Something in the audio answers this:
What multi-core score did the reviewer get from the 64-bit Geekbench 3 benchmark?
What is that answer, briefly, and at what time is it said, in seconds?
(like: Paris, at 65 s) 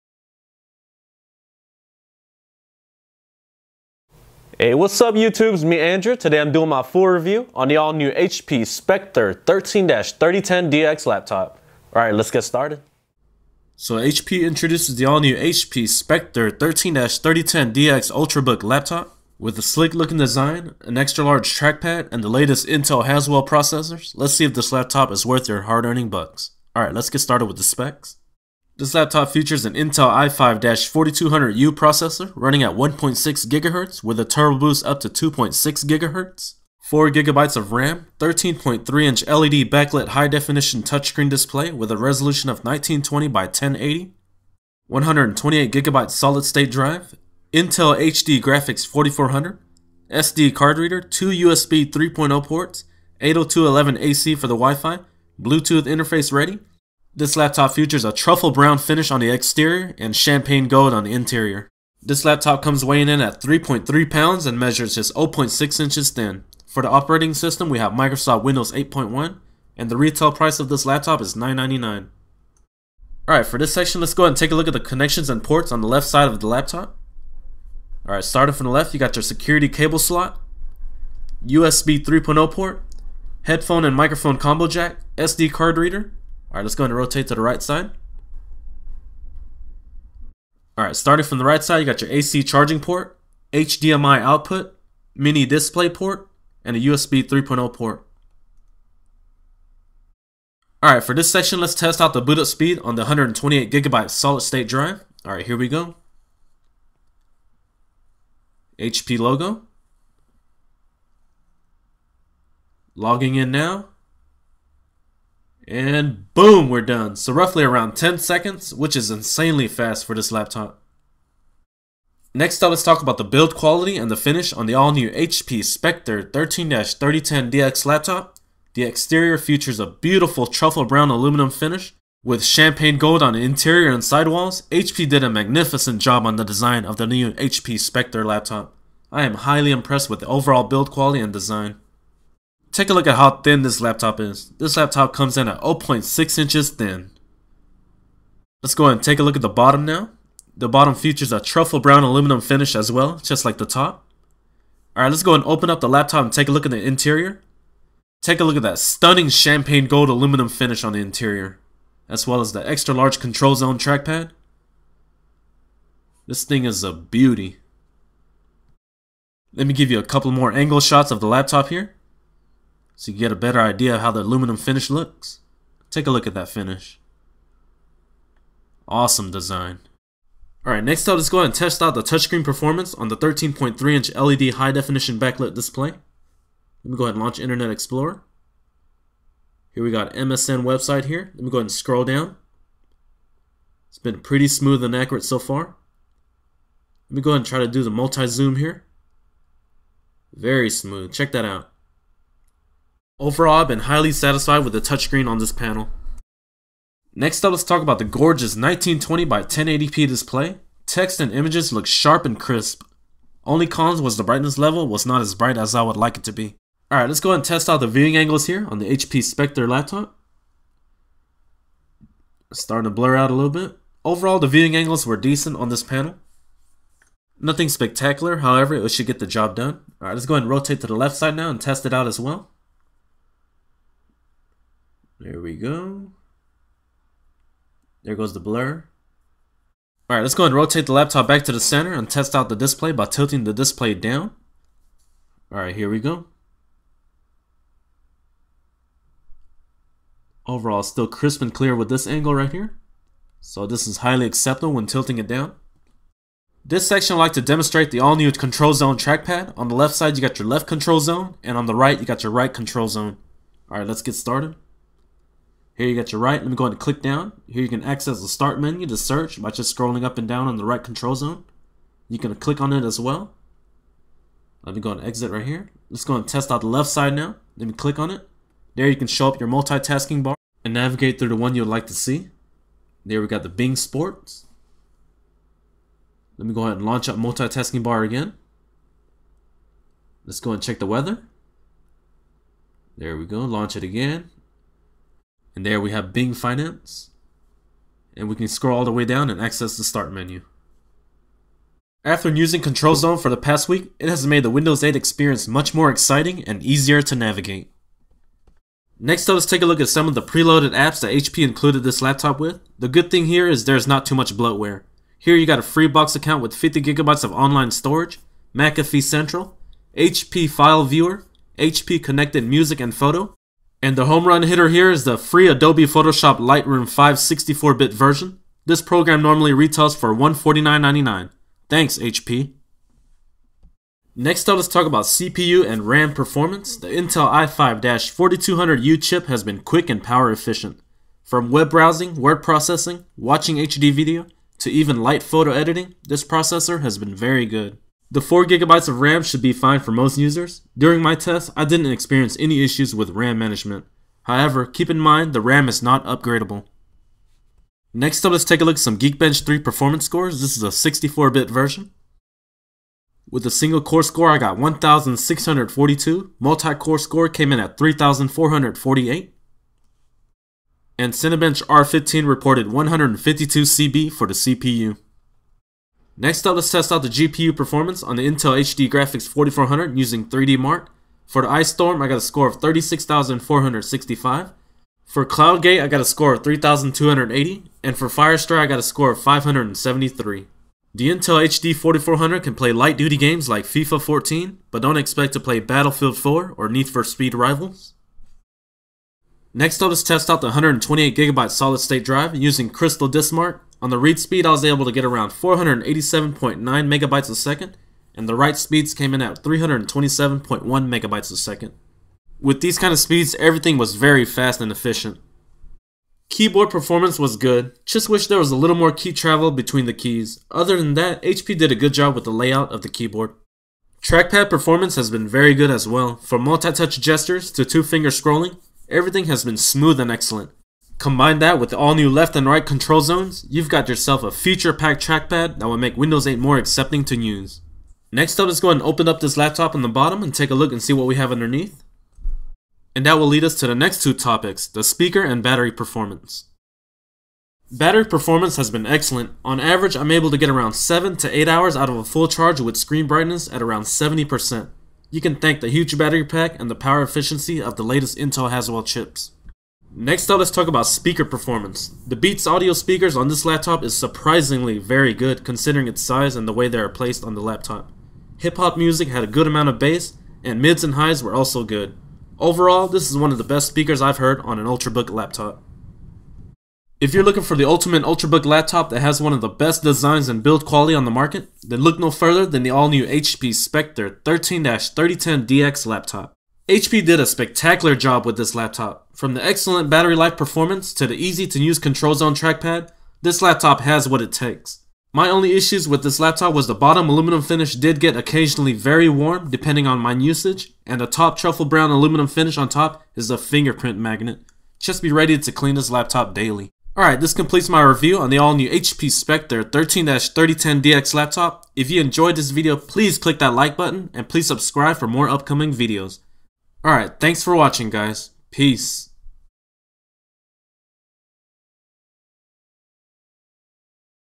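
3,448, at 367 s.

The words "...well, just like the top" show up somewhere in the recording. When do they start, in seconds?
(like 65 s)
152 s.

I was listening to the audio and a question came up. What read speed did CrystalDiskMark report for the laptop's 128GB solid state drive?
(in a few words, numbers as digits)
487.9 MB/s.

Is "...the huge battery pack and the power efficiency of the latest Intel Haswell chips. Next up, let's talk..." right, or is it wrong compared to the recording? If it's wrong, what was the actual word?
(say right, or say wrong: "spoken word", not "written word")
right.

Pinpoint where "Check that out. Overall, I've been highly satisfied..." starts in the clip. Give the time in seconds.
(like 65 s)
201 s.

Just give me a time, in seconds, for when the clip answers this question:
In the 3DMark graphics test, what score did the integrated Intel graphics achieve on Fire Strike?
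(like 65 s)
389 s.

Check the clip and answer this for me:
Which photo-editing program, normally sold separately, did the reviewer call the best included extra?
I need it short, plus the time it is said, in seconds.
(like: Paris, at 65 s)
Adobe Photoshop Lightroom 5, at 325 s.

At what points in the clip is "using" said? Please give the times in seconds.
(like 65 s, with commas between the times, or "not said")
302 s, 379 s, 402 s.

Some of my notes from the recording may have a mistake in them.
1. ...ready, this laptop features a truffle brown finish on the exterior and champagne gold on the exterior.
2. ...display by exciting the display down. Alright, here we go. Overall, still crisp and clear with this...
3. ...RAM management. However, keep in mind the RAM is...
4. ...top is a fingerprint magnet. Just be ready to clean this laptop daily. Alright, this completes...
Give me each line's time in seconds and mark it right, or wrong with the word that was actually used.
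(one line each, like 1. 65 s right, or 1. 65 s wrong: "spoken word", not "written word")
1. 56 s wrong: "interior", not "exterior"
2. 242 s wrong: "tilting", not "exciting"
3. 353 s right
4. 502 s right.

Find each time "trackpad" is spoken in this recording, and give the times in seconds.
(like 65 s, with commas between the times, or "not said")
21 s, 163 s, 258 s, 424 s, 435 s, 492 s.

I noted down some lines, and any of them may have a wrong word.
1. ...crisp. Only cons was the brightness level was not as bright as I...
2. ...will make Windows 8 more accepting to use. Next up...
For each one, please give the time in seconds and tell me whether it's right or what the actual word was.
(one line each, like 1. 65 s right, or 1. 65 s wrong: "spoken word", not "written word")
1. 212 s right
2. 435 s right.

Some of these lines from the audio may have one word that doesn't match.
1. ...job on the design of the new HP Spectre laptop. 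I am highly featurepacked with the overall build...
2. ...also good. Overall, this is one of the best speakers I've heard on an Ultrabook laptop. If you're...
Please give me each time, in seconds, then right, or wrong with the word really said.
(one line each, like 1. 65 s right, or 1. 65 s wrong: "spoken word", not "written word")
1. 136 s wrong: "impressed", not "featurepacked"
2. 471 s right.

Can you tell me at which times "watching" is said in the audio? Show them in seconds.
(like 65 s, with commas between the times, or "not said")
343 s, 517 s.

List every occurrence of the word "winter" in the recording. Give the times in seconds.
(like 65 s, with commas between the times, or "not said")
not said.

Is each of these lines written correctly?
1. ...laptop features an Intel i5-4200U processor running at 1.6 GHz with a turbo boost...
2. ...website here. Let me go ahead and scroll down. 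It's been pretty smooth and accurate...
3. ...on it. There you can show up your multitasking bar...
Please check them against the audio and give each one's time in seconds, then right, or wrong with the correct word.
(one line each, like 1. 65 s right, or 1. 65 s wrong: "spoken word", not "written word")
1. 28 s right
2. 190 s right
3. 277 s right.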